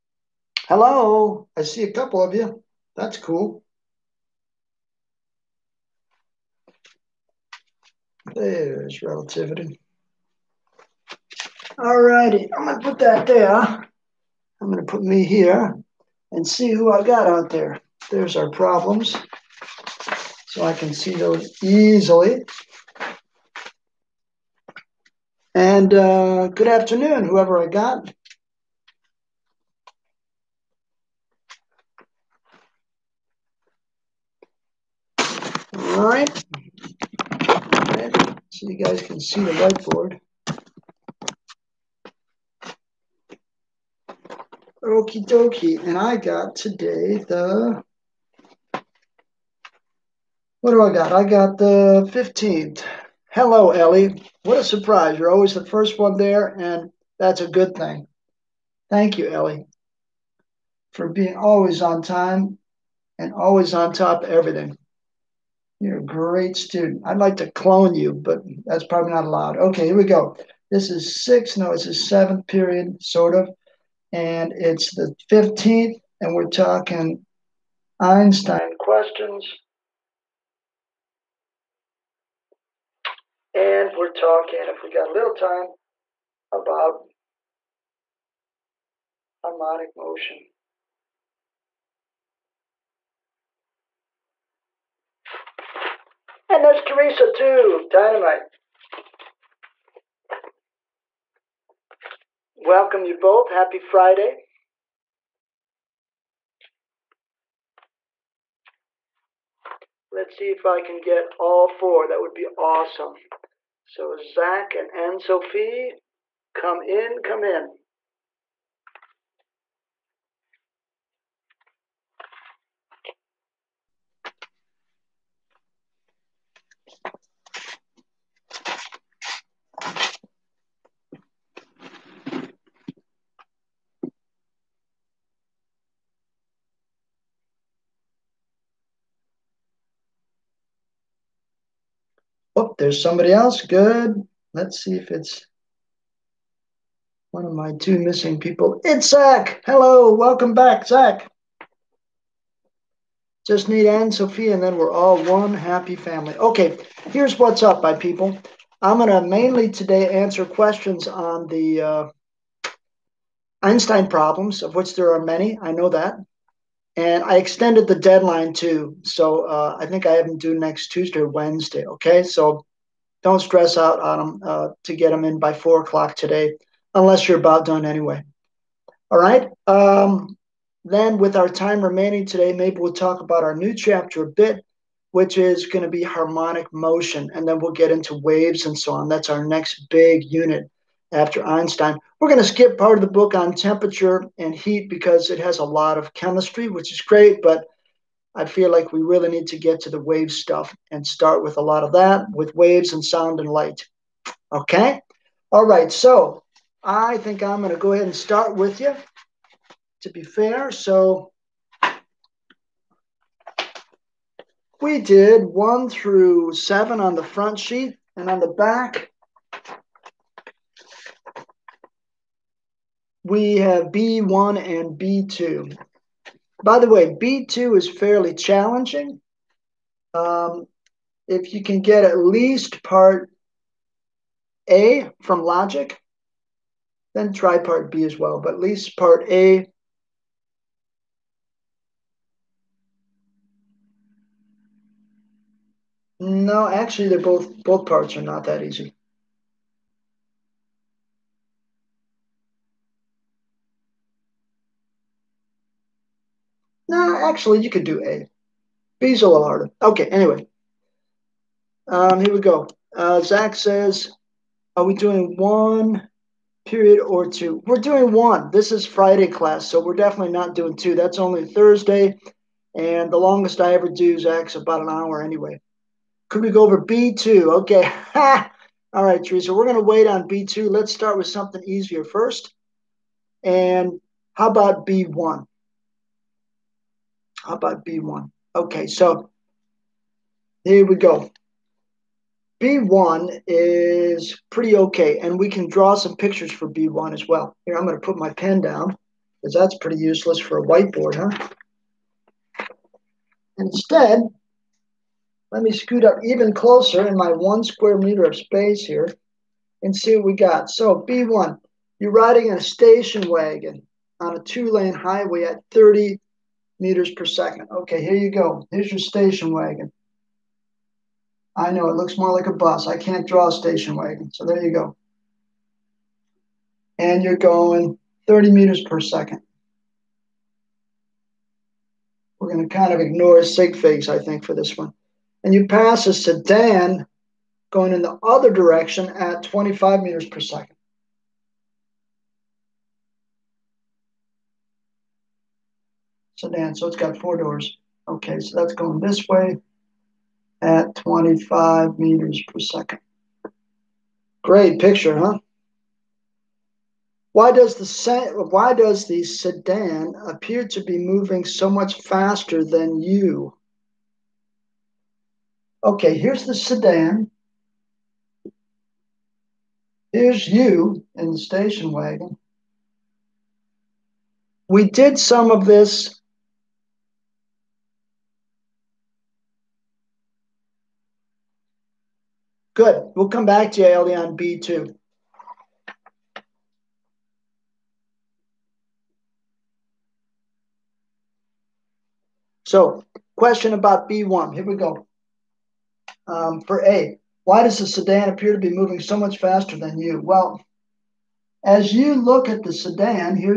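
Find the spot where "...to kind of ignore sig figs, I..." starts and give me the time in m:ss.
5:32.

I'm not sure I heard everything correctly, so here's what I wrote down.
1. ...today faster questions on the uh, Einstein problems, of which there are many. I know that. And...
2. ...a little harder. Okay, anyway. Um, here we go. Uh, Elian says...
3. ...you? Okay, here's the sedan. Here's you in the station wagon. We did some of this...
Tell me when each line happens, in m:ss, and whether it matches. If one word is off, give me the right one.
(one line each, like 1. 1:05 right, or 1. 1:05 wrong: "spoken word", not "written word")
1. 2:39 wrong: "answer", not "faster"
2. 4:19 wrong: "Zach", not "Elian"
3. 6:03 right.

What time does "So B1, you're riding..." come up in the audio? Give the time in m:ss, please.
5:10.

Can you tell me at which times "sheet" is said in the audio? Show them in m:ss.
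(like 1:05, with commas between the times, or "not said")
3:37.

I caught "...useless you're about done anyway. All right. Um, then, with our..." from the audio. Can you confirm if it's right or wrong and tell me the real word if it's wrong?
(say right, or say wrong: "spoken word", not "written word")
wrong: "unless", not "useless".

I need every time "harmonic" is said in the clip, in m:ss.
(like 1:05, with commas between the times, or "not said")
1:29, 3:06.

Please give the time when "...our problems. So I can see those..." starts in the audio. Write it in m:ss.
0:18.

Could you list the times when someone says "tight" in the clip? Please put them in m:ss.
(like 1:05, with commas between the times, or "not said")
not said.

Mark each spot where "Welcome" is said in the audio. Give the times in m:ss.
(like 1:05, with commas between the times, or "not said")
1:42, 2:30.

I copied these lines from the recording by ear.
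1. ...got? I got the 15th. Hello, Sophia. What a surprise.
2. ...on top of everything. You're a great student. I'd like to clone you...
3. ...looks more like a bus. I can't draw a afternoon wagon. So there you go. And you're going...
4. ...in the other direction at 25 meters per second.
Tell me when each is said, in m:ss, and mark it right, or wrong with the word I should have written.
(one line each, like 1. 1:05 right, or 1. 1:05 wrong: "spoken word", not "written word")
1. 0:50 wrong: "Ellie", not "Sophia"
2. 1:03 right
3. 5:21 wrong: "station", not "afternoon"
4. 5:37 right.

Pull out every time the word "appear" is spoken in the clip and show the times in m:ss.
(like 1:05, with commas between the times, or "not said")
6:00, 6:38.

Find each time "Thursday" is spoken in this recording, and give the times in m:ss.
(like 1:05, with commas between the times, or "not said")
4:31.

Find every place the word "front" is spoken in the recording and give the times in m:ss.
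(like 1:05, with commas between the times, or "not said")
3:37.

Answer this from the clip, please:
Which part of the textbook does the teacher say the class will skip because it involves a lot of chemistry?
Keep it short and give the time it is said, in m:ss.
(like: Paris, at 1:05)
temperature and heat, at 3:13.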